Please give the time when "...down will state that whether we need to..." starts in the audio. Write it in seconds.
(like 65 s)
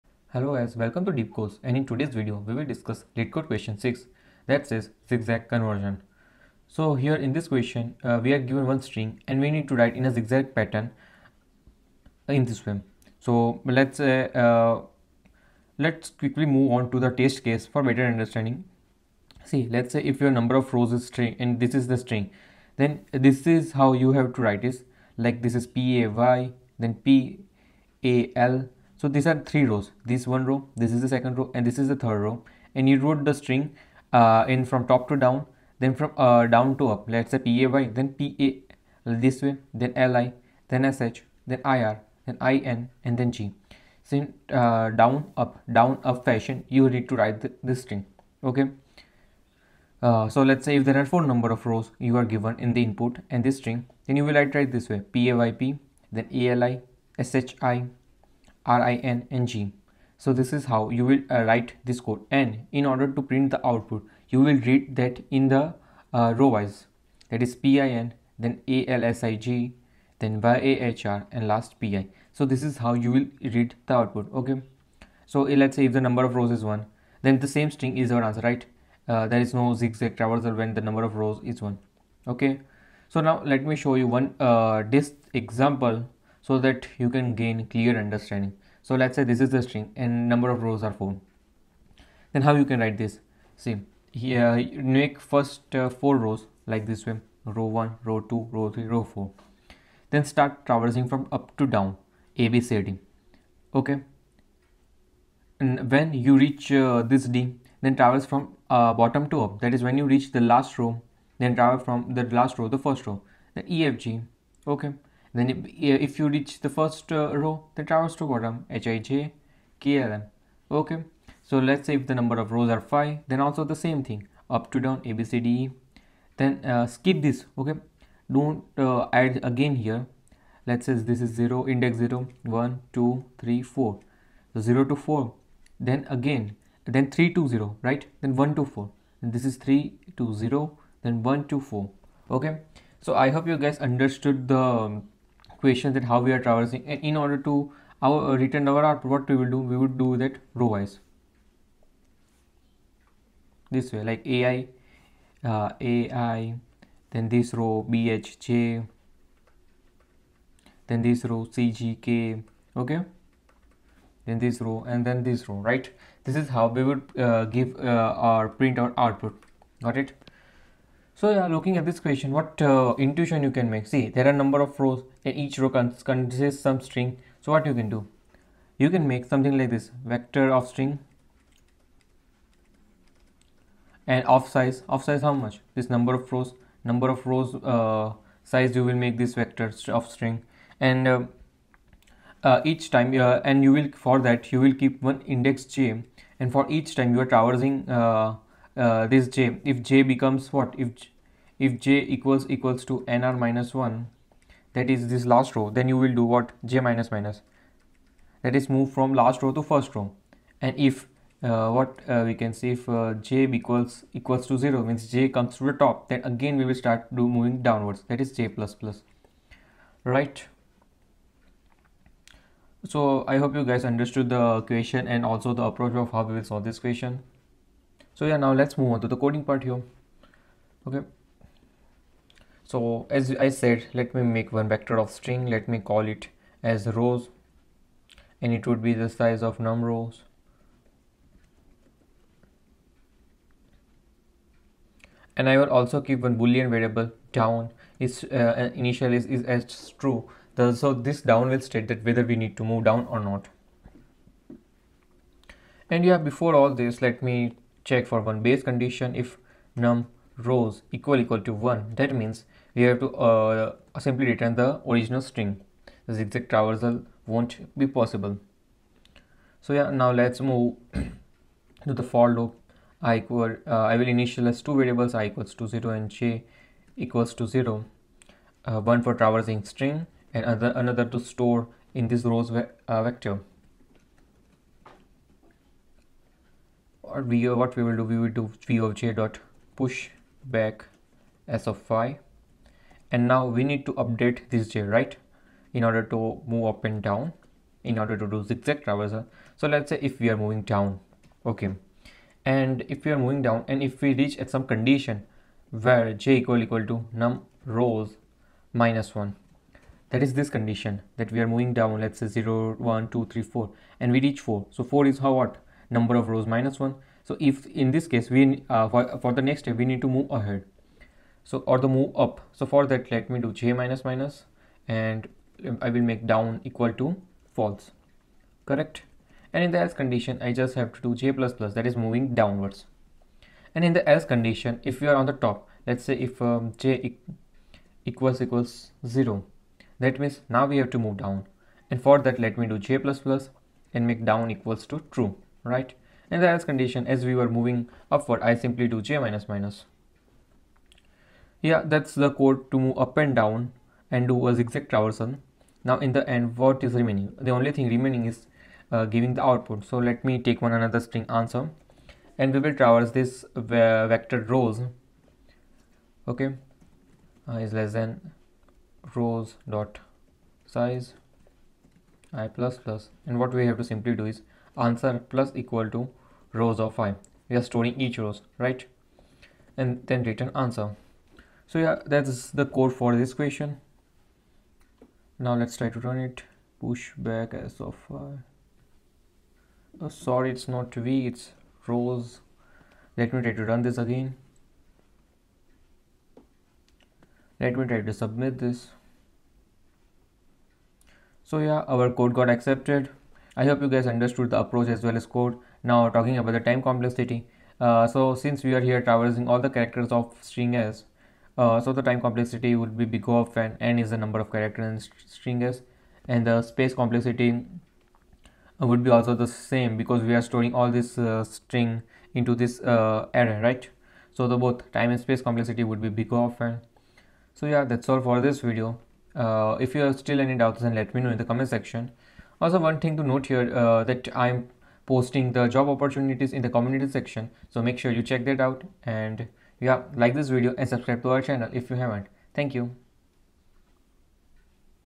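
251 s.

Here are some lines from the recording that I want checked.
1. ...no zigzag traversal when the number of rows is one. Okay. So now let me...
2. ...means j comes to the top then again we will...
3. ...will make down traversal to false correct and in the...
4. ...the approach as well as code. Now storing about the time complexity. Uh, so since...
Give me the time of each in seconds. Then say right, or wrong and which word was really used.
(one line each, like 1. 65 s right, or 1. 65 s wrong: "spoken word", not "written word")
1. 79 s right
2. 214 s right
3. 325 s wrong: "equal", not "traversal"
4. 404 s wrong: "talking", not "storing".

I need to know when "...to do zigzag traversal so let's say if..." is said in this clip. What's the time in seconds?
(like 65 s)
298 s.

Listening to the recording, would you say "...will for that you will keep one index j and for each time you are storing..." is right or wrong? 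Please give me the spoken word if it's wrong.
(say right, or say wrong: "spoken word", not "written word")
wrong: "traversing", not "storing".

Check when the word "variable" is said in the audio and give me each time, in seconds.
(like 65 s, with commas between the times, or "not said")
246 s, 274 s.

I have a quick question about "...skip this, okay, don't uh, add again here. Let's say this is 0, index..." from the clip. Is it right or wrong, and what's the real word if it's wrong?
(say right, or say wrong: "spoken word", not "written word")
right.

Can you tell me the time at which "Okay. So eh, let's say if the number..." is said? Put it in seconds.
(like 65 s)
74 s.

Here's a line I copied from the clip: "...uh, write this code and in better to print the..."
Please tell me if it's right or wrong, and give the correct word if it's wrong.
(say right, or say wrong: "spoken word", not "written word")
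wrong: "order", not "better".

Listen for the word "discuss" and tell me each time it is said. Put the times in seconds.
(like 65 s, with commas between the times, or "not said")
2 s.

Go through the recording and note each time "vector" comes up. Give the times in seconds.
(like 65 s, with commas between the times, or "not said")
180 s, 189 s, 234 s, 283 s, 363 s.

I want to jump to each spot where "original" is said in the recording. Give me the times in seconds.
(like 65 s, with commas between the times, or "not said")
264 s.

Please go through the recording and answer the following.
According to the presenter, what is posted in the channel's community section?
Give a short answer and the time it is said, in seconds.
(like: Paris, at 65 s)
job opportunities, at 435 s.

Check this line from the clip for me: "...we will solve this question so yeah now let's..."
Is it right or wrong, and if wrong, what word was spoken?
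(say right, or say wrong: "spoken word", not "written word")
right.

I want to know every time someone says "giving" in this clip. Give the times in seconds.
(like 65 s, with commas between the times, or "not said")
359 s.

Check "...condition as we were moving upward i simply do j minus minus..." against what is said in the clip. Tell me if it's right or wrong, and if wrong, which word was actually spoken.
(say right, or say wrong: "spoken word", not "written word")
right.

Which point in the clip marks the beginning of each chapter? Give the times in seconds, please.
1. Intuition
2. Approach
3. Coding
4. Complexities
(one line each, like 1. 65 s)
1. 85 s
2. 180 s
3. 230 s
4. 403 s.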